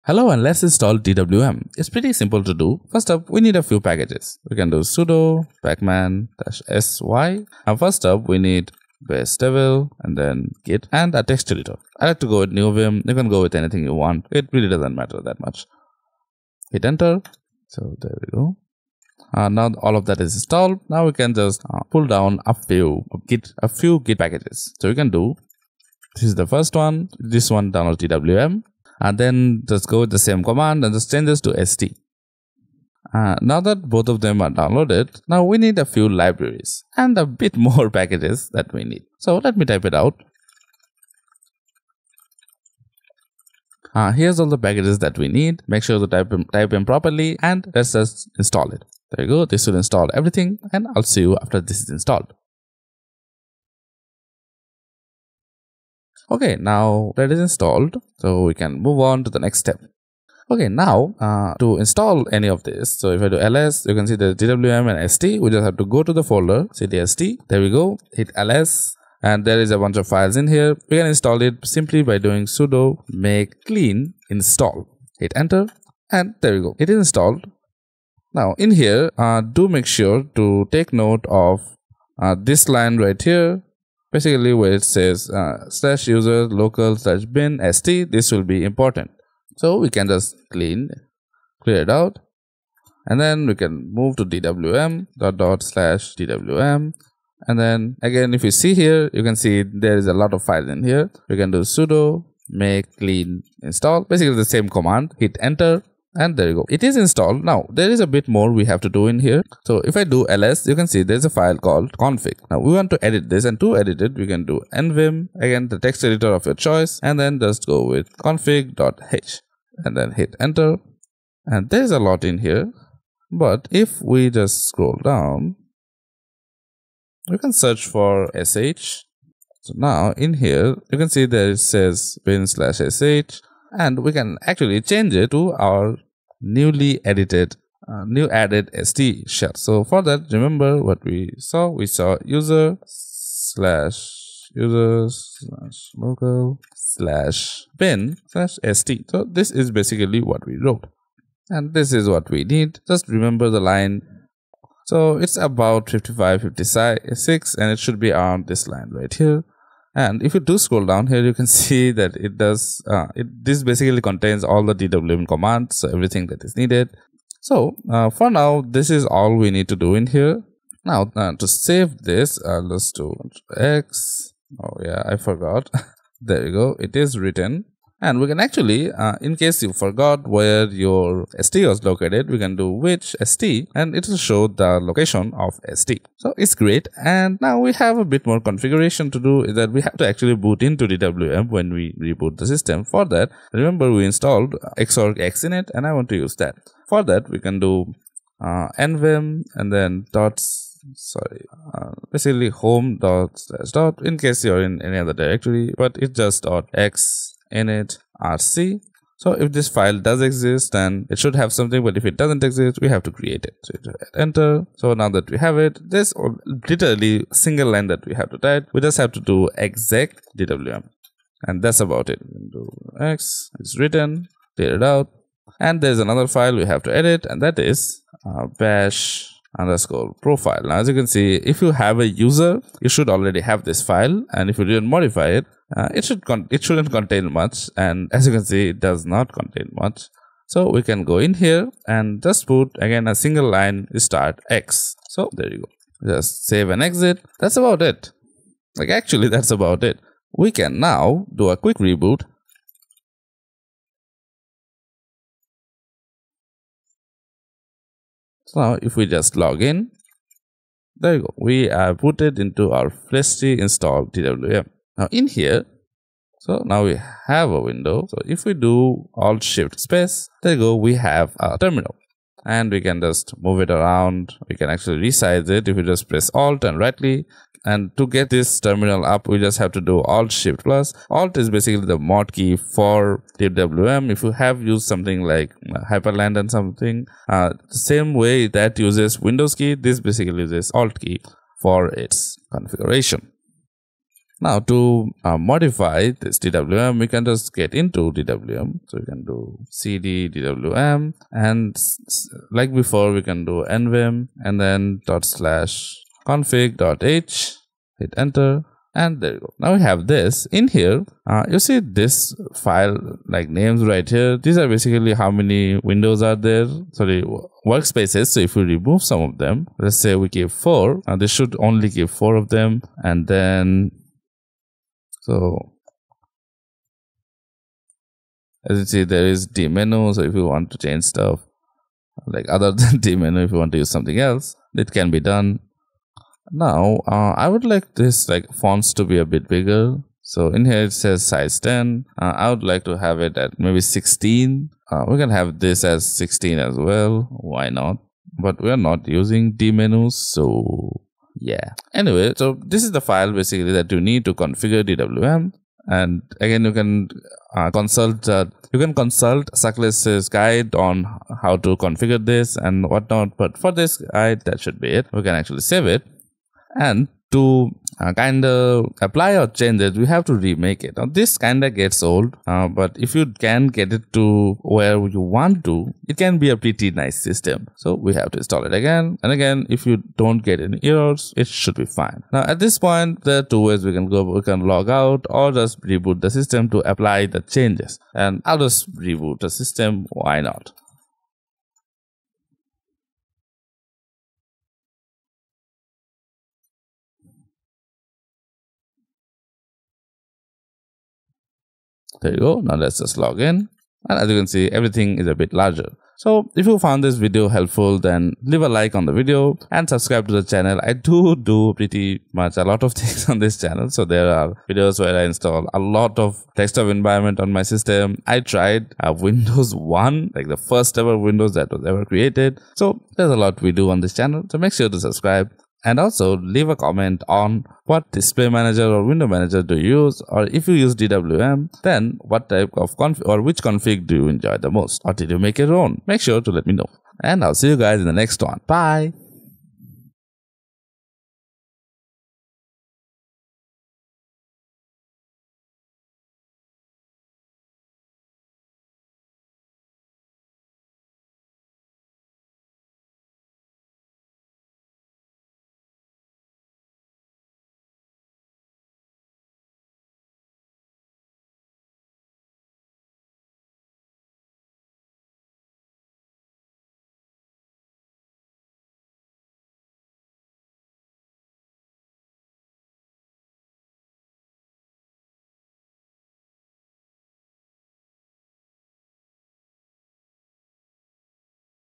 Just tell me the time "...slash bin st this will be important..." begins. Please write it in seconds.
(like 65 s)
86 s.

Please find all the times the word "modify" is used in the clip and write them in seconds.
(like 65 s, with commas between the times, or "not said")
234 s, 295 s.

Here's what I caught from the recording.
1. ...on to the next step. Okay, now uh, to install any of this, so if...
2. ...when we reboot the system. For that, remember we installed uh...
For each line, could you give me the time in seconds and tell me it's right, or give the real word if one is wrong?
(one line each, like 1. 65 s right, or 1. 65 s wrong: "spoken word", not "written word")
1. 59 s right
2. 191 s right.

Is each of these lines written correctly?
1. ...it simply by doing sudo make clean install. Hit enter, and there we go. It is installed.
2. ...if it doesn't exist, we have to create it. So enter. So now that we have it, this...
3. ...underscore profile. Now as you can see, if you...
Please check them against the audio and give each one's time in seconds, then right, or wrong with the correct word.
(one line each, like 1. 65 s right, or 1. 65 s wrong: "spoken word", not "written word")
1. 71 s right
2. 211 s right
3. 229 s right.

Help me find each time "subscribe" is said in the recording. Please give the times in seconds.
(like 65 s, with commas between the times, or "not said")
409 s, 424 s.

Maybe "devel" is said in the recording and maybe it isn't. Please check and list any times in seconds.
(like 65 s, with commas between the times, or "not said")
9 s.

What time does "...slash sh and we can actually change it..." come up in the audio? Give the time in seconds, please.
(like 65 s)
132 s.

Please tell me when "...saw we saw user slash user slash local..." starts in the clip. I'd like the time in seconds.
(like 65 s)
141 s.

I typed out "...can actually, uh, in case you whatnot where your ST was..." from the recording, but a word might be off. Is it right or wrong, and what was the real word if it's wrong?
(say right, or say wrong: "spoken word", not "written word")
wrong: "forgot", not "whatnot".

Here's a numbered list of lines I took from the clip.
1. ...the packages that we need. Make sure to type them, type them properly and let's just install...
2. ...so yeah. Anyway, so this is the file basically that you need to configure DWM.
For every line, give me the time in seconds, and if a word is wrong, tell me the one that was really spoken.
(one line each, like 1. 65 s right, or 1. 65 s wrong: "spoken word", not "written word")
1. 44 s right
2. 350 s right.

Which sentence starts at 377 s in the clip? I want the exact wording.
So, we have to install it again.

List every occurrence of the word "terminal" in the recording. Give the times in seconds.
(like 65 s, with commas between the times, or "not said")
271 s, 278 s.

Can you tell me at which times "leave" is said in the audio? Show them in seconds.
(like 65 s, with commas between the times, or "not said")
408 s, 426 s.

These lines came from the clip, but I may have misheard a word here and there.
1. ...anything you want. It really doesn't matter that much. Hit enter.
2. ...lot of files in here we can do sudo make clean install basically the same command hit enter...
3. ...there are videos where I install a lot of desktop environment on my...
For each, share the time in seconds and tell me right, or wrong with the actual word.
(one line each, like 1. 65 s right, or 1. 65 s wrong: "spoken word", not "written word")
1. 13 s right
2. 100 s right
3. 414 s right.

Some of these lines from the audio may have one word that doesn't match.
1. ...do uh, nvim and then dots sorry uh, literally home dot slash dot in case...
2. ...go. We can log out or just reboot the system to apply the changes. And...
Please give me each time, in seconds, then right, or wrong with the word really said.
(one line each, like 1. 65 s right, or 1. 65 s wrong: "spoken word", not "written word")
1. 197 s wrong: "basically", not "literally"
2. 384 s right.